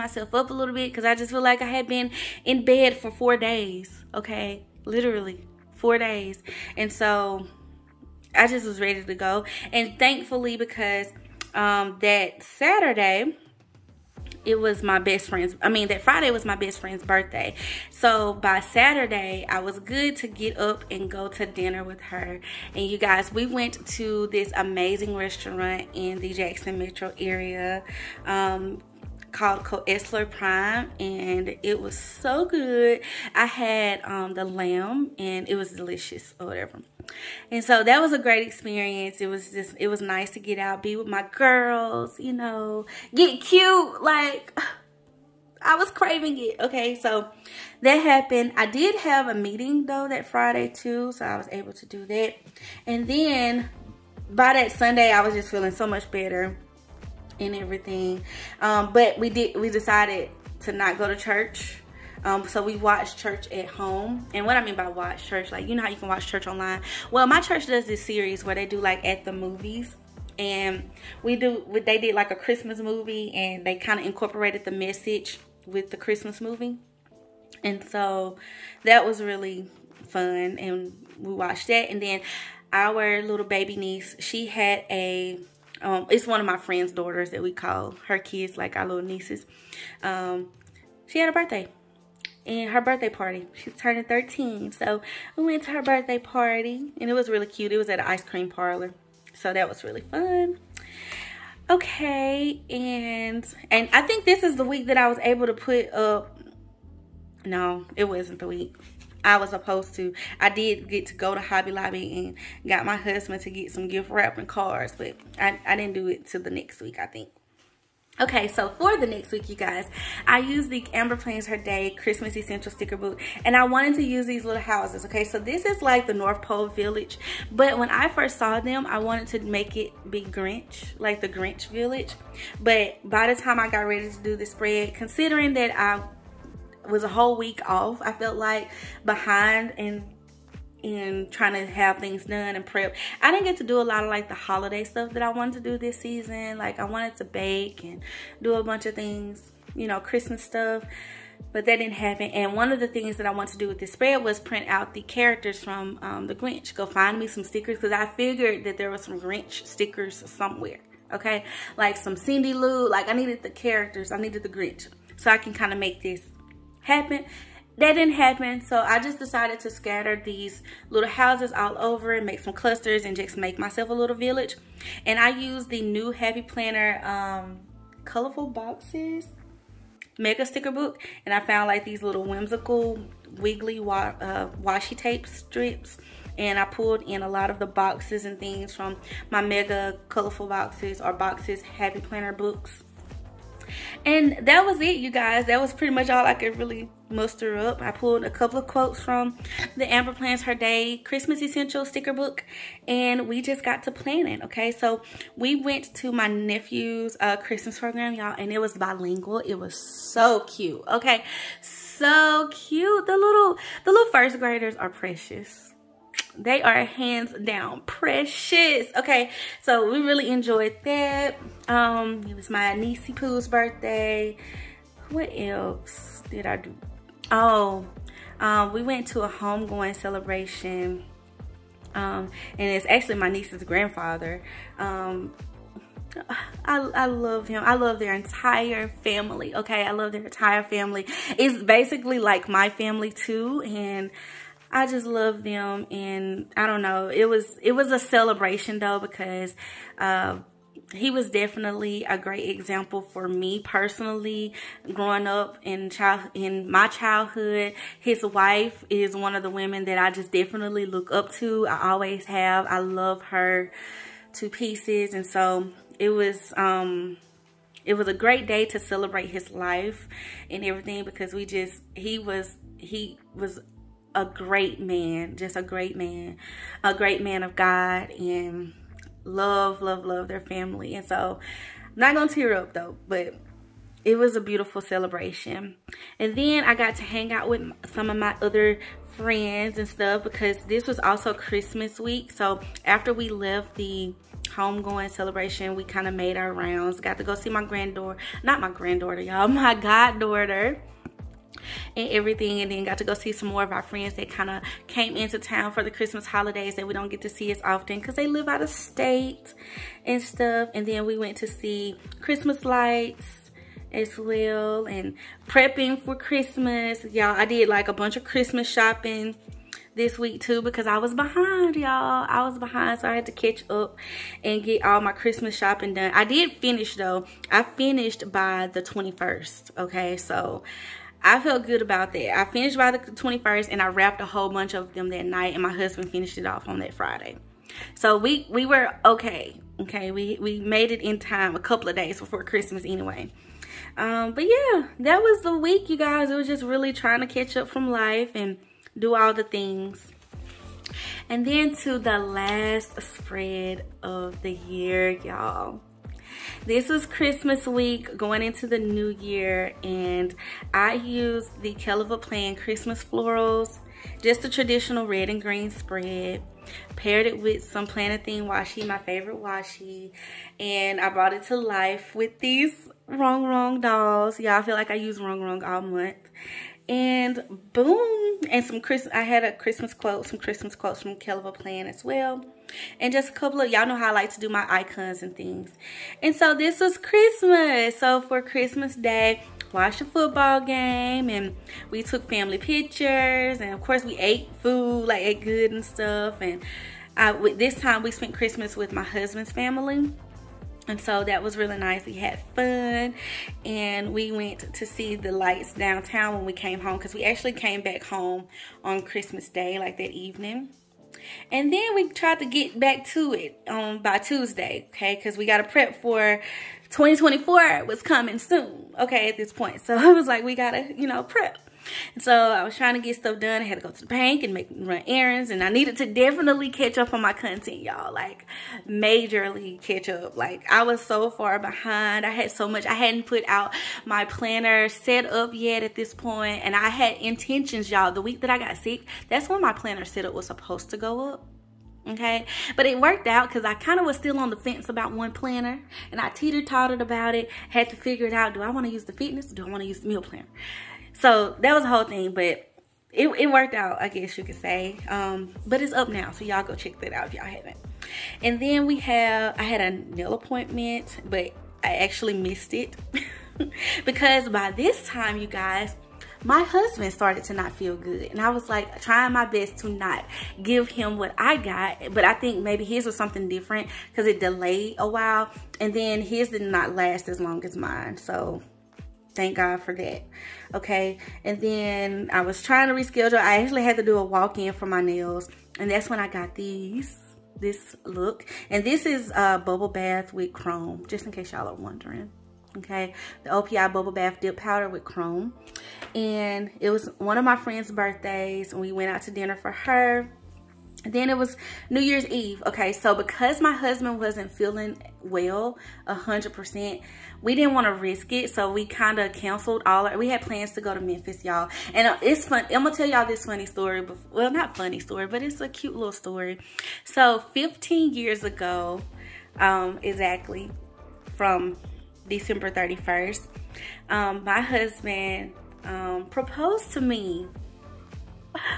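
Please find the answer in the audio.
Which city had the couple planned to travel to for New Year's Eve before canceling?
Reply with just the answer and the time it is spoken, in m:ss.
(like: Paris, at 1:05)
Memphis, at 8:30.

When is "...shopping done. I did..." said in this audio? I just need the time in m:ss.
5:25.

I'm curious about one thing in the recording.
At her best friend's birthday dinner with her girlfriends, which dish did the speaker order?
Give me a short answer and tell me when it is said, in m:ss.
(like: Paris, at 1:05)
Lamb, at 0:34.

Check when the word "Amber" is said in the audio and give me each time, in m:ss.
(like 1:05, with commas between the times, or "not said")
2:00, 3:19.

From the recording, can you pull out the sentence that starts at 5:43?
Um, but yeah, that was the week, you guys.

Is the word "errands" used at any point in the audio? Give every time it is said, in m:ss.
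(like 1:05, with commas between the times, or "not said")
7:05.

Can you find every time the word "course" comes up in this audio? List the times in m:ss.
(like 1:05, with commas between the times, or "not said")
6:33.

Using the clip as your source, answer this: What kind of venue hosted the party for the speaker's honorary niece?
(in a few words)
Ice cream parlor.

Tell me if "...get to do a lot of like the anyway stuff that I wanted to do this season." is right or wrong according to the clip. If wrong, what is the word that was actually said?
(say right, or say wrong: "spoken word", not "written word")
wrong: "holiday", not "anyway".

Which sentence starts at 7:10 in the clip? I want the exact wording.
Like, I was so far behind.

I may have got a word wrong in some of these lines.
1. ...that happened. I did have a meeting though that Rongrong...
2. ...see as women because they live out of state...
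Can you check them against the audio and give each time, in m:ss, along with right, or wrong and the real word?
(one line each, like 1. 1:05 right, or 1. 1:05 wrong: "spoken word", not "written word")
1. 0:47 wrong: "Friday", not "Rongrong"
2. 5:07 wrong: "often", not "women".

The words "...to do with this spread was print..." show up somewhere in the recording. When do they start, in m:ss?
2:33.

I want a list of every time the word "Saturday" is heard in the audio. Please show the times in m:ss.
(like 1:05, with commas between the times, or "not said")
0:12, 0:18.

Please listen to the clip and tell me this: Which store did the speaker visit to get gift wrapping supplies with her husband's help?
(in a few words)
Hobby Lobby.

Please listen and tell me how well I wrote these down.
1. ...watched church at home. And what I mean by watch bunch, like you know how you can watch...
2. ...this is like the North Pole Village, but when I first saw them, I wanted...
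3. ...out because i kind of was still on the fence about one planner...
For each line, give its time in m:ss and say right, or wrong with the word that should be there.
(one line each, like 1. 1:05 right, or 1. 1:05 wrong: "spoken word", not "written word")
1. 1:02 wrong: "church", not "bunch"
2. 2:05 right
3. 7:23 right.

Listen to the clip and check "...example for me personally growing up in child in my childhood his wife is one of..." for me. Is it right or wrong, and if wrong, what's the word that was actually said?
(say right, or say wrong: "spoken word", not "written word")
right.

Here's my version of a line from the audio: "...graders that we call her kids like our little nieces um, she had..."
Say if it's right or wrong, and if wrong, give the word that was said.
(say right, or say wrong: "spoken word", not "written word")
wrong: "daughters", not "graders".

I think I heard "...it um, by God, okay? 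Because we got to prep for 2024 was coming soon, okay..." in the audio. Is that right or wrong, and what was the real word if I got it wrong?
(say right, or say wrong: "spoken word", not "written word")
wrong: "Tuesday", not "God".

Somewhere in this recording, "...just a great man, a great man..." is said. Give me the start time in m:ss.
4:35.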